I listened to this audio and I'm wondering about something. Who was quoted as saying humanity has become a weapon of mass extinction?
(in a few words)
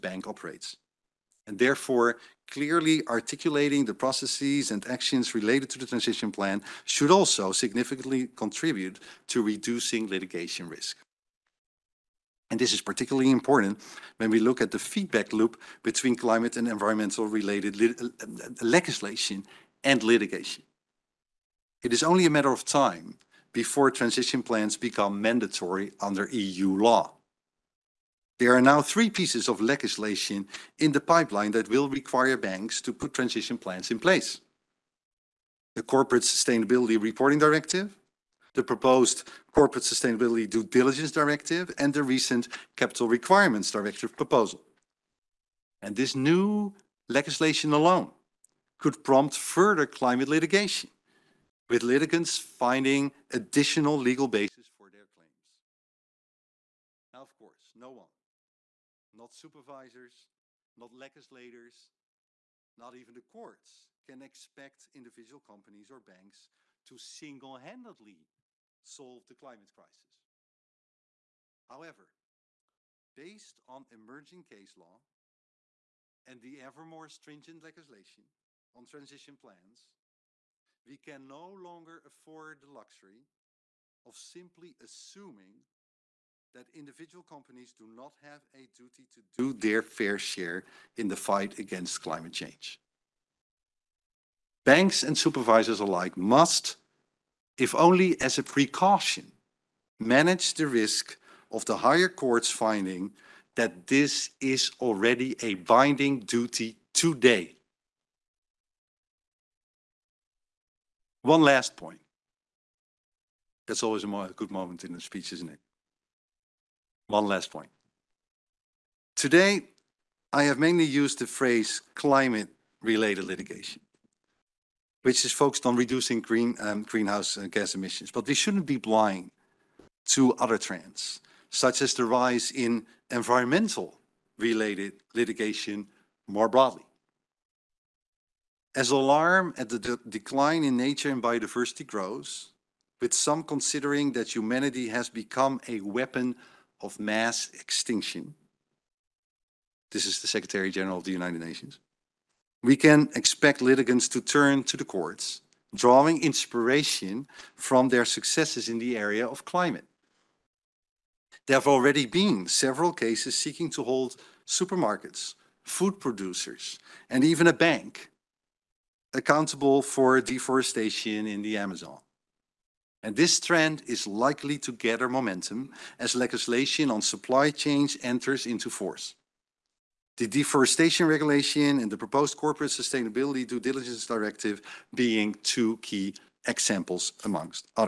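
Secretary General of the United Nations.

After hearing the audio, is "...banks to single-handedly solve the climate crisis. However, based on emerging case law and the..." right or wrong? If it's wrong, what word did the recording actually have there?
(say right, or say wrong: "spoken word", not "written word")
right.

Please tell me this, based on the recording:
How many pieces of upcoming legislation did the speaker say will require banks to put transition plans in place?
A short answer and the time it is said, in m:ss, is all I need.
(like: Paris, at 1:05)
3, at 0:28.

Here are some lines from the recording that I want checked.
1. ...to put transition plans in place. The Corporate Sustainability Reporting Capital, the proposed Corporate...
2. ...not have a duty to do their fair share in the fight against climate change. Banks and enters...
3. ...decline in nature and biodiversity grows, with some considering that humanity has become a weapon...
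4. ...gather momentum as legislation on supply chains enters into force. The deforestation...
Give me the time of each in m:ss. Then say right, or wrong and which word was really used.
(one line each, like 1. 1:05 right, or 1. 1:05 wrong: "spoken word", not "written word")
1. 0:32 wrong: "Directive", not "Capital"
2. 1:27 wrong: "supervisors", not "enters"
3. 2:20 right
4. 2:54 right.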